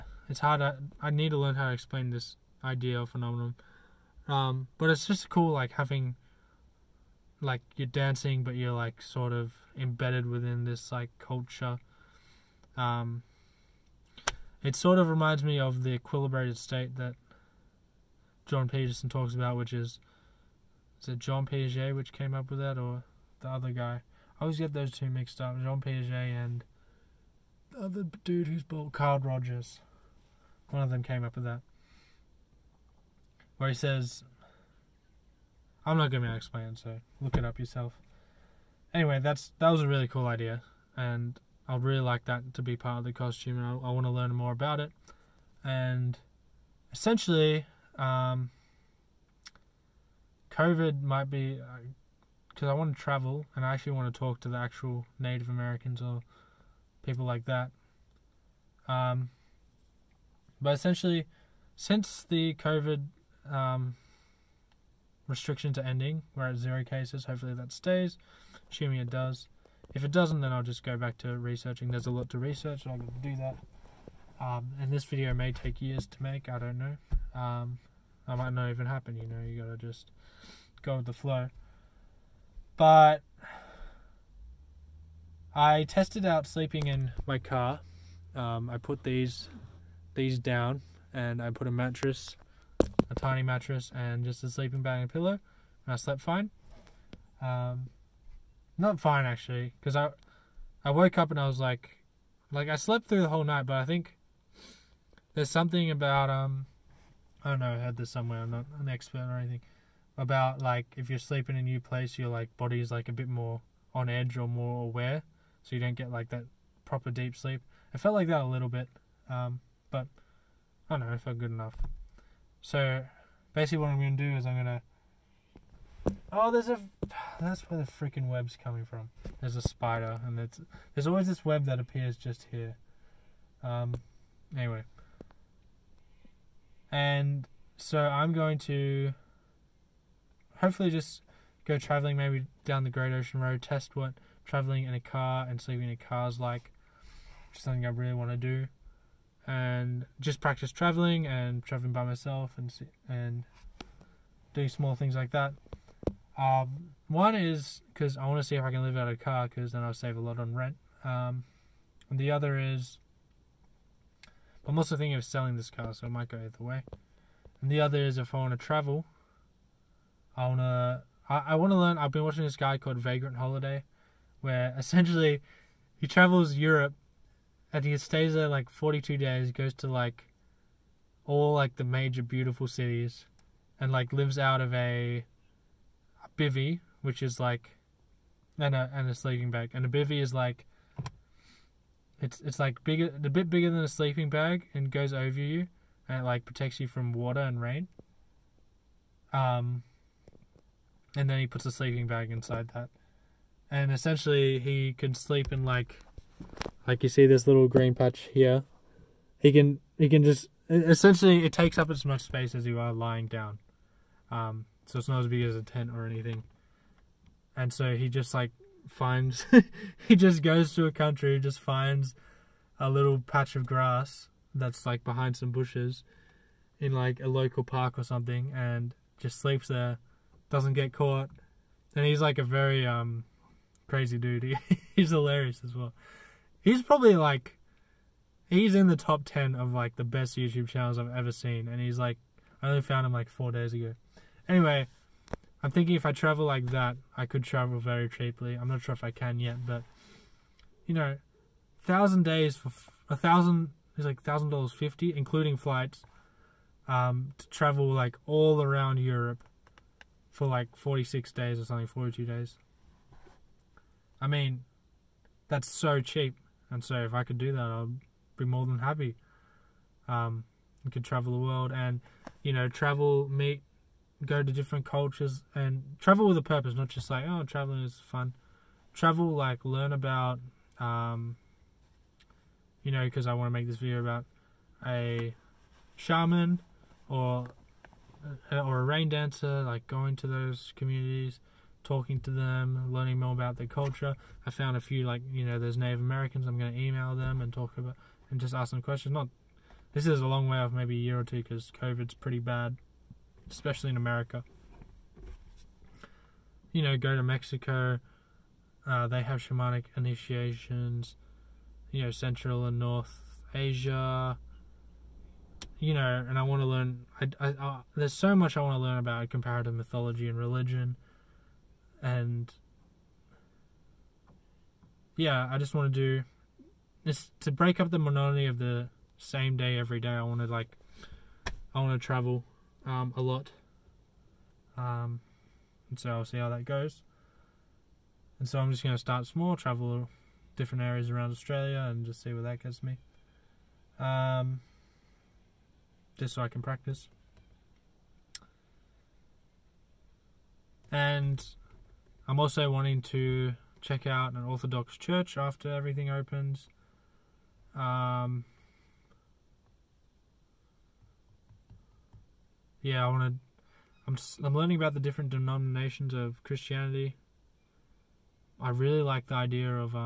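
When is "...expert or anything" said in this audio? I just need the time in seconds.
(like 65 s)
108 s.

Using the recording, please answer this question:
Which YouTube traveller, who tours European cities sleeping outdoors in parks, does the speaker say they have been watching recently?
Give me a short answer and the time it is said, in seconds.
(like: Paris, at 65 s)
Vagrant Holiday, at 172 s.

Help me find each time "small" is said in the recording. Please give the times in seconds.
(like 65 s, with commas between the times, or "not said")
154 s, 339 s.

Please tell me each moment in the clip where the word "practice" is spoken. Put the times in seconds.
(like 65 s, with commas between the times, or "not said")
150 s, 346 s.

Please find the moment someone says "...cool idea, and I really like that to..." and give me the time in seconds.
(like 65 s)
40 s.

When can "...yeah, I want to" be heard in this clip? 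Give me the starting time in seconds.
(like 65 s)
362 s.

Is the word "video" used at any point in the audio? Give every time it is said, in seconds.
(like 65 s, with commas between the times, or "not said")
75 s, 283 s.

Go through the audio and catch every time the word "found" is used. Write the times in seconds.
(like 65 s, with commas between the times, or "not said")
242 s, 294 s.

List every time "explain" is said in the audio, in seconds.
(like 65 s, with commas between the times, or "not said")
1 s, 36 s.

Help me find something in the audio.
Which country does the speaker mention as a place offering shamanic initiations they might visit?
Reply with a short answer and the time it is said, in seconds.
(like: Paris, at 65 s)
Mexico, at 307 s.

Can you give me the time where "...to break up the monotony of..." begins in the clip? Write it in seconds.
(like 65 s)
327 s.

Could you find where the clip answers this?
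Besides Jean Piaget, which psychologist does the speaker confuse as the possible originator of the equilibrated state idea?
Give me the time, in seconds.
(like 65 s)
28 s.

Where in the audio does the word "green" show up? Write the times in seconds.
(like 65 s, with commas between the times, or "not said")
207 s.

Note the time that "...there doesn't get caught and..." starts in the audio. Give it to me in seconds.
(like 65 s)
229 s.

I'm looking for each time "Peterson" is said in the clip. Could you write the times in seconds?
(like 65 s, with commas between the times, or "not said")
18 s.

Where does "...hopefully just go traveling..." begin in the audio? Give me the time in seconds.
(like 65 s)
140 s.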